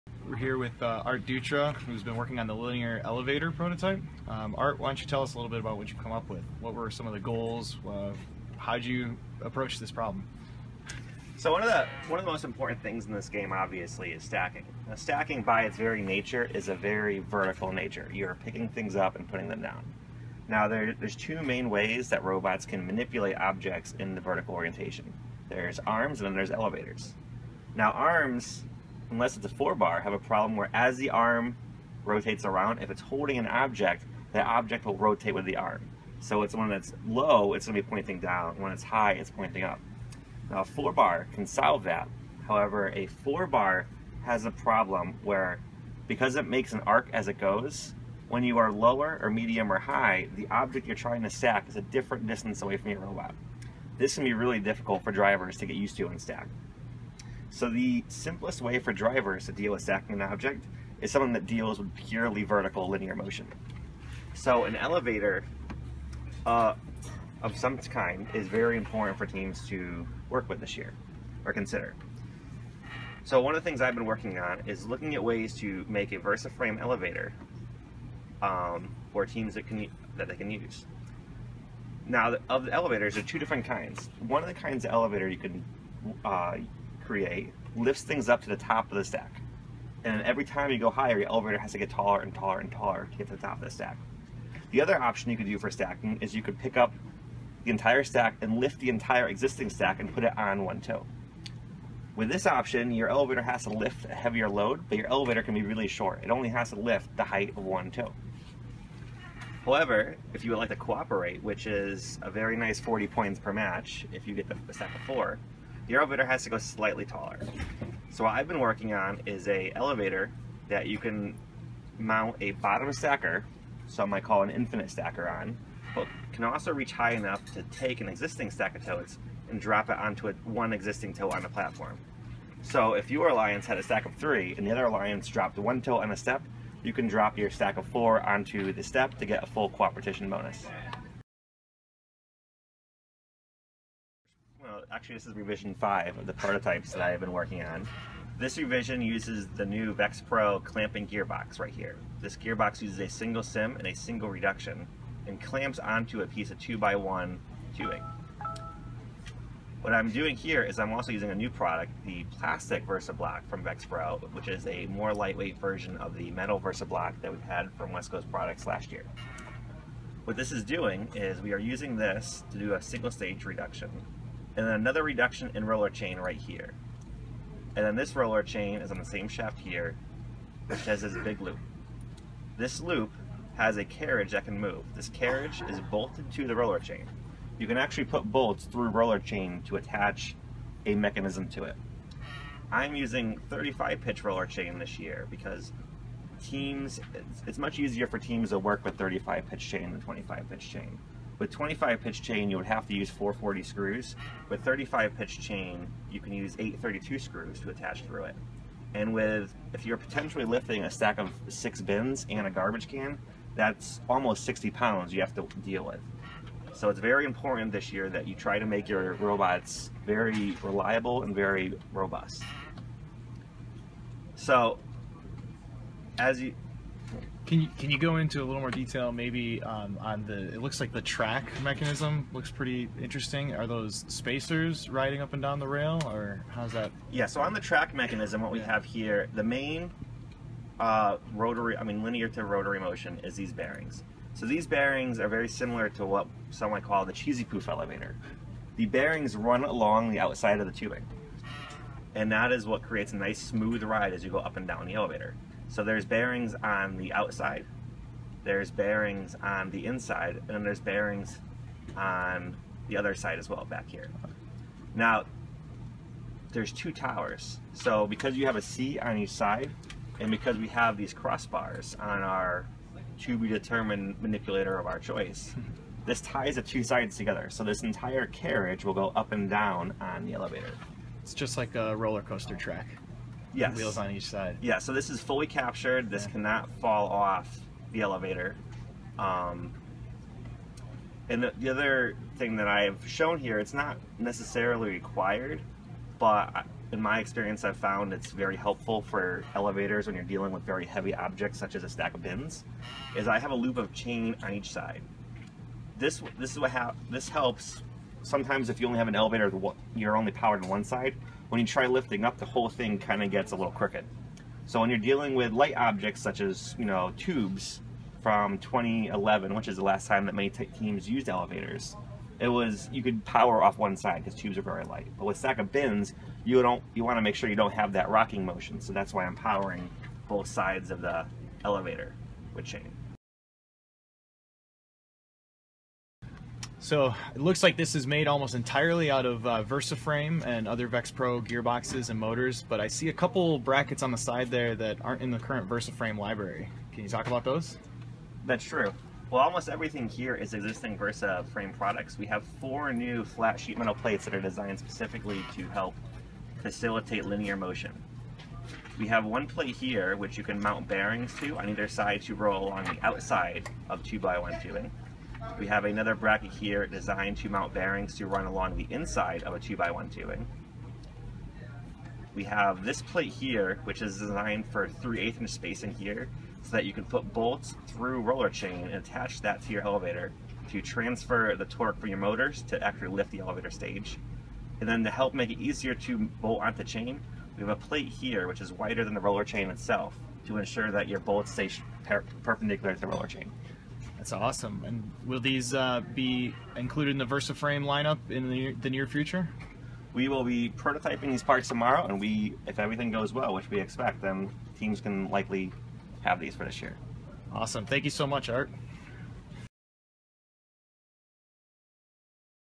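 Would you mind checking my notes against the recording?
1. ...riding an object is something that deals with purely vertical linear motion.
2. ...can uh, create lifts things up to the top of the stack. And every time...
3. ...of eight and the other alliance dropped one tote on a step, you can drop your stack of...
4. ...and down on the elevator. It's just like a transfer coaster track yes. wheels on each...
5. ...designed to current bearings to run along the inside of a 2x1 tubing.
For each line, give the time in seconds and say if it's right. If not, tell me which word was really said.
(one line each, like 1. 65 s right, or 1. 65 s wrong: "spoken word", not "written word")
1. 59 s wrong: "stacking", not "riding"
2. 85 s right
3. 134 s wrong: "three", not "eight"
4. 279 s wrong: "roller", not "transfer"
5. 366 s wrong: "mount", not "current".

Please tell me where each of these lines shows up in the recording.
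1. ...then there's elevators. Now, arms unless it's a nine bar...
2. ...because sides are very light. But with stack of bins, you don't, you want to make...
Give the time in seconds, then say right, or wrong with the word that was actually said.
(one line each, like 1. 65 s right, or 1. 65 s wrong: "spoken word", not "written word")
1. 26 s wrong: "four", not "nine"
2. 324 s wrong: "tubes", not "sides".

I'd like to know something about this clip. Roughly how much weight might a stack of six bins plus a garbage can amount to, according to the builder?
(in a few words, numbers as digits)
60 pounds.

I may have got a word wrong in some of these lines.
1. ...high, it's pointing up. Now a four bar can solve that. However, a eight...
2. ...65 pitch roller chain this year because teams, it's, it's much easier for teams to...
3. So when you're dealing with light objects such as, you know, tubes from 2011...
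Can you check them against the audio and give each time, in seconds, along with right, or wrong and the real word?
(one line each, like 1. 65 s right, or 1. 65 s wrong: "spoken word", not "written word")
1. 38 s wrong: "four", not "eight"
2. 193 s wrong: "35", not "65"
3. 314 s right.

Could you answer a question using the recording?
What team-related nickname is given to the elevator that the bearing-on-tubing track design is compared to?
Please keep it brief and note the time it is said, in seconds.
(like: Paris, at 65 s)
cheesy poof elevator, at 247 s.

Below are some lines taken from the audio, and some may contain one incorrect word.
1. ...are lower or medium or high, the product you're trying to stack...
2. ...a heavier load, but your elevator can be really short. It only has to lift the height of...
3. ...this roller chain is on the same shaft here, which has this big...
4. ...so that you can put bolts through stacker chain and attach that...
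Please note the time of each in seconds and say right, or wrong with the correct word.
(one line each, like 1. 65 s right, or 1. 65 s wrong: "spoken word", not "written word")
1. 48 s wrong: "object", not "product"
2. 104 s right
3. 177 s right
4. 376 s wrong: "roller", not "stacker".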